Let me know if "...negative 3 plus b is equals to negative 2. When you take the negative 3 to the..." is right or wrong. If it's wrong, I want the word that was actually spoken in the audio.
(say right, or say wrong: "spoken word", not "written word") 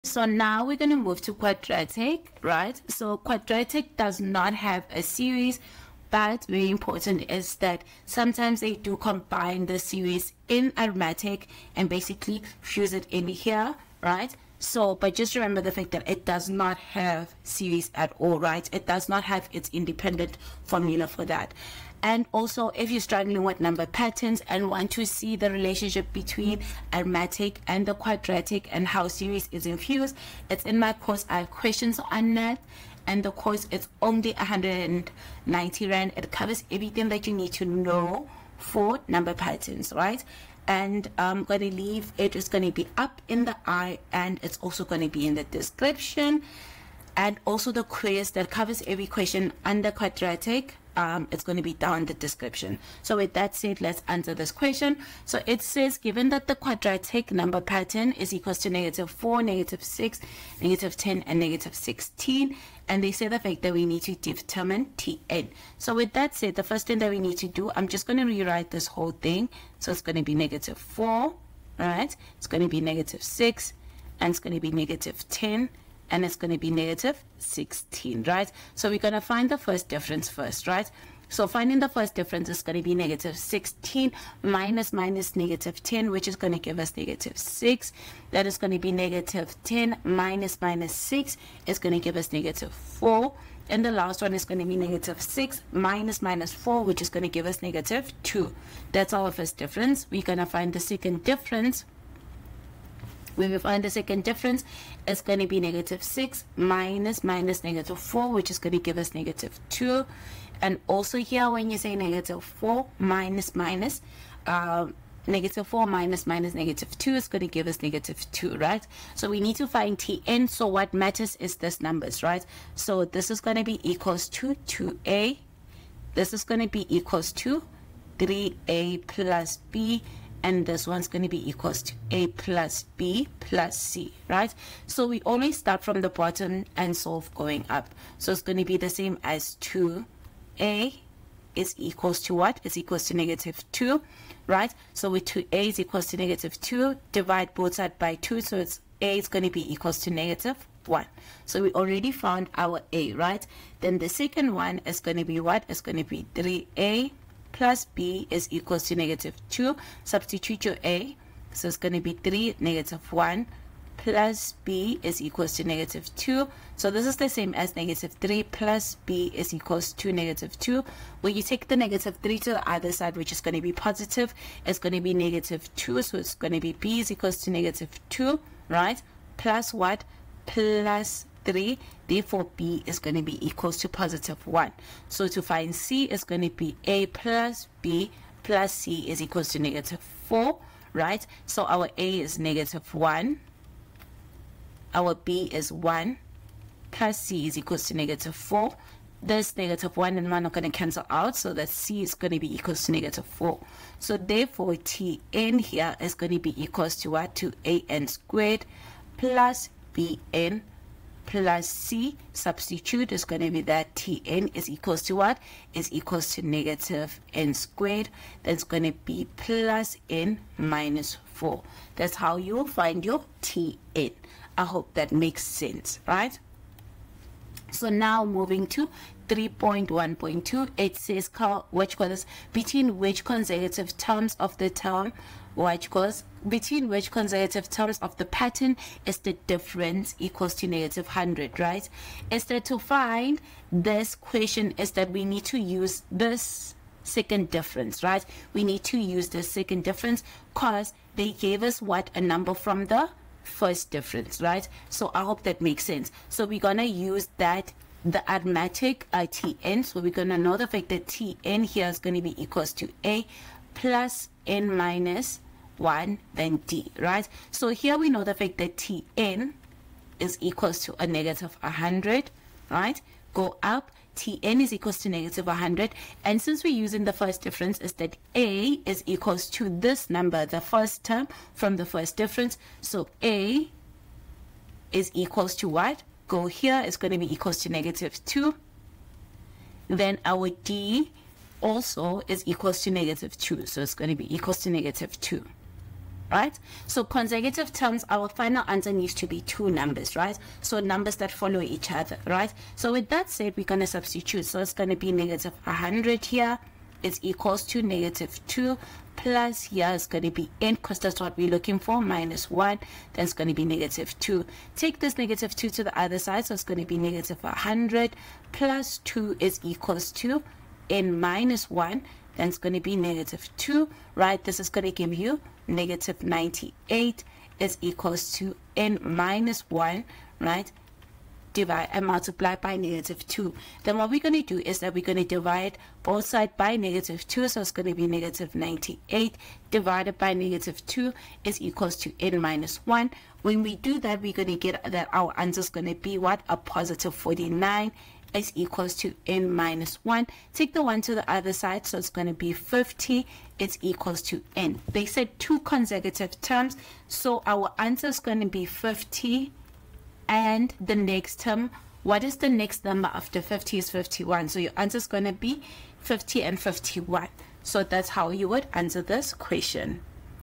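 right.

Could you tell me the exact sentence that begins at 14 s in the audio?
So, but just remember the fact that it does not have series at all, right?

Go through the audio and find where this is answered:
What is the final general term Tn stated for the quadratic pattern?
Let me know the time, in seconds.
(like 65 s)
216 s.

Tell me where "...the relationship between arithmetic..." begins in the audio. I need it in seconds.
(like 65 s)
25 s.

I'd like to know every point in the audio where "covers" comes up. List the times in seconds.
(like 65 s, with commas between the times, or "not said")
36 s, 48 s.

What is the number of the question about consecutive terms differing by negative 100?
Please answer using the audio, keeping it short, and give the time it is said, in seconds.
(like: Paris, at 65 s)
3.1.2, at 229 s.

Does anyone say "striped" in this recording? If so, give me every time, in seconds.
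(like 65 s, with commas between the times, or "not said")
not said.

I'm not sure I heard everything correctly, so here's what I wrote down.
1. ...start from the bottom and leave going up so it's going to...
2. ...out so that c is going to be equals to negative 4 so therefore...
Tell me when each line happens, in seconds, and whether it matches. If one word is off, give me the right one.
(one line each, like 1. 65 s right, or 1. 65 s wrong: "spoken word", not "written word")
1. 135 s wrong: "solve", not "leave"
2. 201 s right.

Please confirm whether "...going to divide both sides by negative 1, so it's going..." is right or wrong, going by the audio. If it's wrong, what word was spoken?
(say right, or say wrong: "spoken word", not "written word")
wrong: "2", not "1".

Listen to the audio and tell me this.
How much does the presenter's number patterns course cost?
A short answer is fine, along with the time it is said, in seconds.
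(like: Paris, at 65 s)
190 Rand, at 34 s.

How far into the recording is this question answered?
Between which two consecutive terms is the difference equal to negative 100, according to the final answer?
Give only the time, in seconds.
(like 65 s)
365 s.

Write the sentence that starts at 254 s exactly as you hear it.
So I hope that makes sense.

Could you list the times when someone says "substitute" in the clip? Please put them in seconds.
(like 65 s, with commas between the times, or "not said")
160 s, 212 s, 303 s.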